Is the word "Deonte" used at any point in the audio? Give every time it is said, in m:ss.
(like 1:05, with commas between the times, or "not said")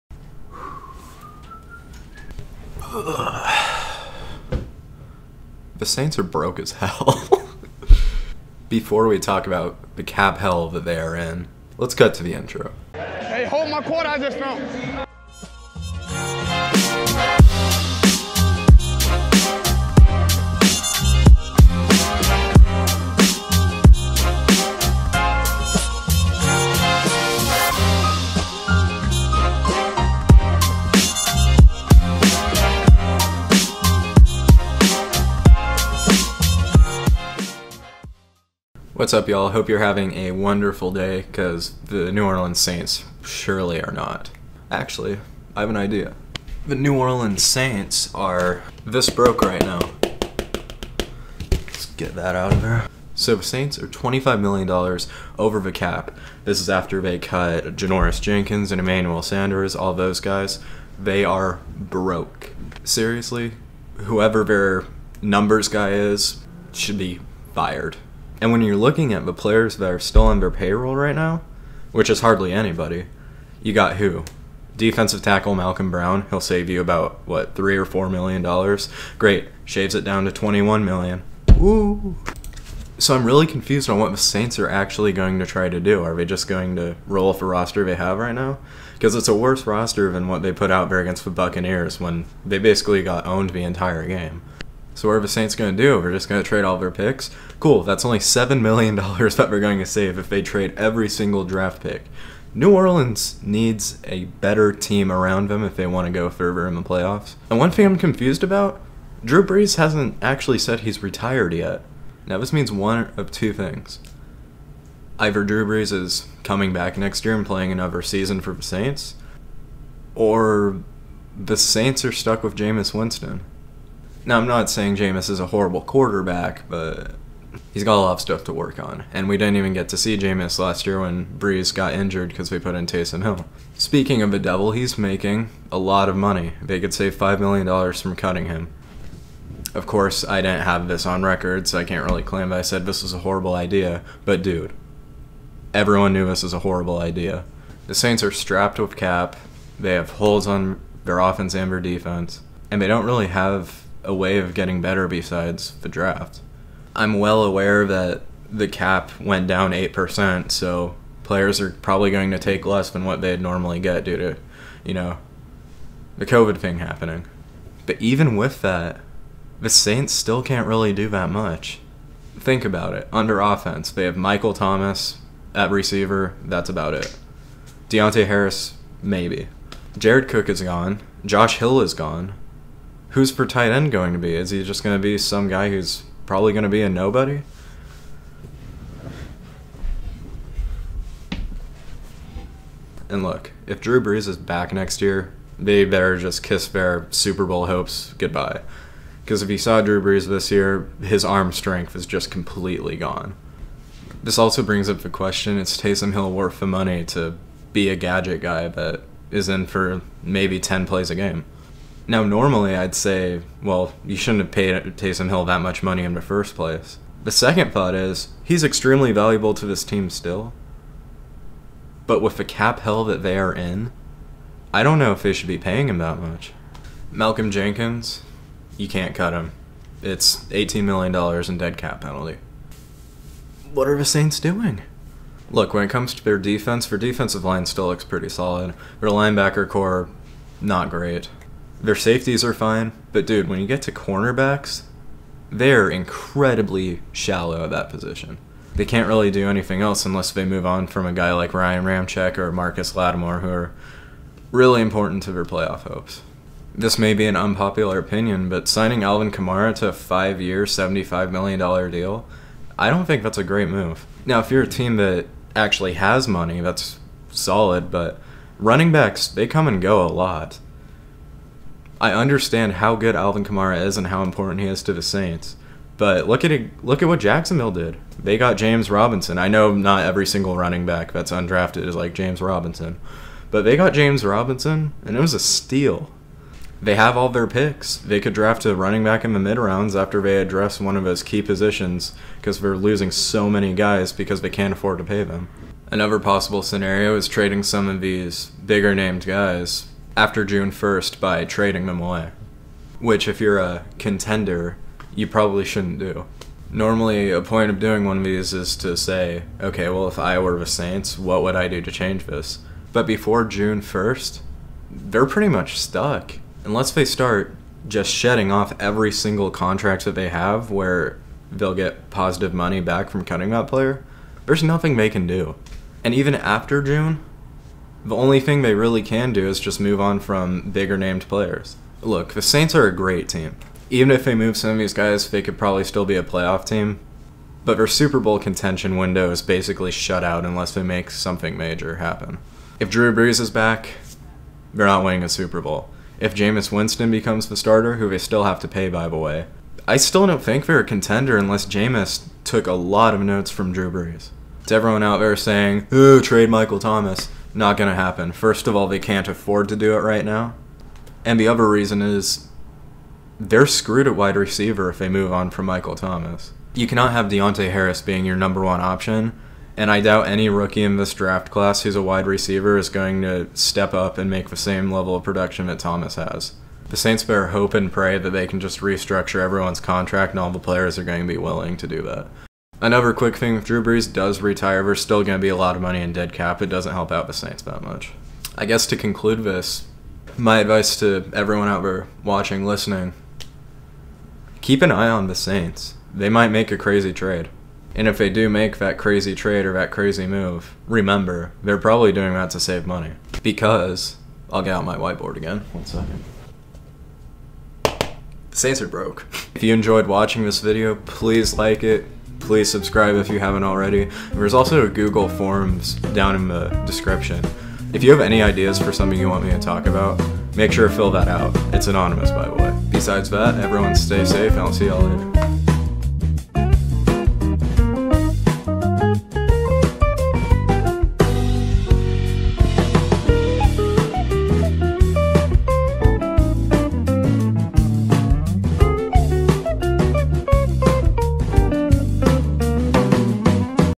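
2:57, 6:07.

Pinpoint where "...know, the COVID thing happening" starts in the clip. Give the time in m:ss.
2:44.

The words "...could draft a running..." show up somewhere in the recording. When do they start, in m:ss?
4:48.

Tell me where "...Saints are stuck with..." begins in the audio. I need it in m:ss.
2:01.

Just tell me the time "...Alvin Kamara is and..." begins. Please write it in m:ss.
4:33.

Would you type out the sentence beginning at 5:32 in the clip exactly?
Look, the Saints are a great team.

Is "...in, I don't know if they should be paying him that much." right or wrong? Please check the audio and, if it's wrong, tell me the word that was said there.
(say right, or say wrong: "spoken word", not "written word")
right.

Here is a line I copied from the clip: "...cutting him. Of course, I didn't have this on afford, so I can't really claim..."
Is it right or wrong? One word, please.
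wrong.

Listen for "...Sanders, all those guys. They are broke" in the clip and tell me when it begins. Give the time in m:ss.
0:59.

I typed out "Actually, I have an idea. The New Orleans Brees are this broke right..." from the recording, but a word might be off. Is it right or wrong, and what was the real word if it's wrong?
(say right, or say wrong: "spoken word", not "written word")
wrong: "Saints", not "Brees".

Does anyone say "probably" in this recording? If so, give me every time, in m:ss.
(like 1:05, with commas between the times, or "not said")
2:41, 3:06, 5:05, 5:35, 6:41.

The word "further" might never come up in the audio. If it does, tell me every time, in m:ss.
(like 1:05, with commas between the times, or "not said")
1:46.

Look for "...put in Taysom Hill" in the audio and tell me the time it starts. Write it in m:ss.
2:12.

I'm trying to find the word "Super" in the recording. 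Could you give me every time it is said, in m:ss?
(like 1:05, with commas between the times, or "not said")
3:17, 5:37, 5:45.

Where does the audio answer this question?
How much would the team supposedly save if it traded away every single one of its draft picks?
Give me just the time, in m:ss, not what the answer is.
1:38.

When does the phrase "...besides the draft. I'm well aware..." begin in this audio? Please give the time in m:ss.
2:35.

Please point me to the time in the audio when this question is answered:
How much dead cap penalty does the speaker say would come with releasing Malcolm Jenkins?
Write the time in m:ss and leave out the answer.
3:50.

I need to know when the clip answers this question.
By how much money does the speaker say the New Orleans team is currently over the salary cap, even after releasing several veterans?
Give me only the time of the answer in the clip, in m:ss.
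0:53.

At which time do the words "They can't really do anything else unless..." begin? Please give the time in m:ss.
4:08.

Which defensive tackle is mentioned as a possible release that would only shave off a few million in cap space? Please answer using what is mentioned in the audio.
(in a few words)
Malcolm Brown.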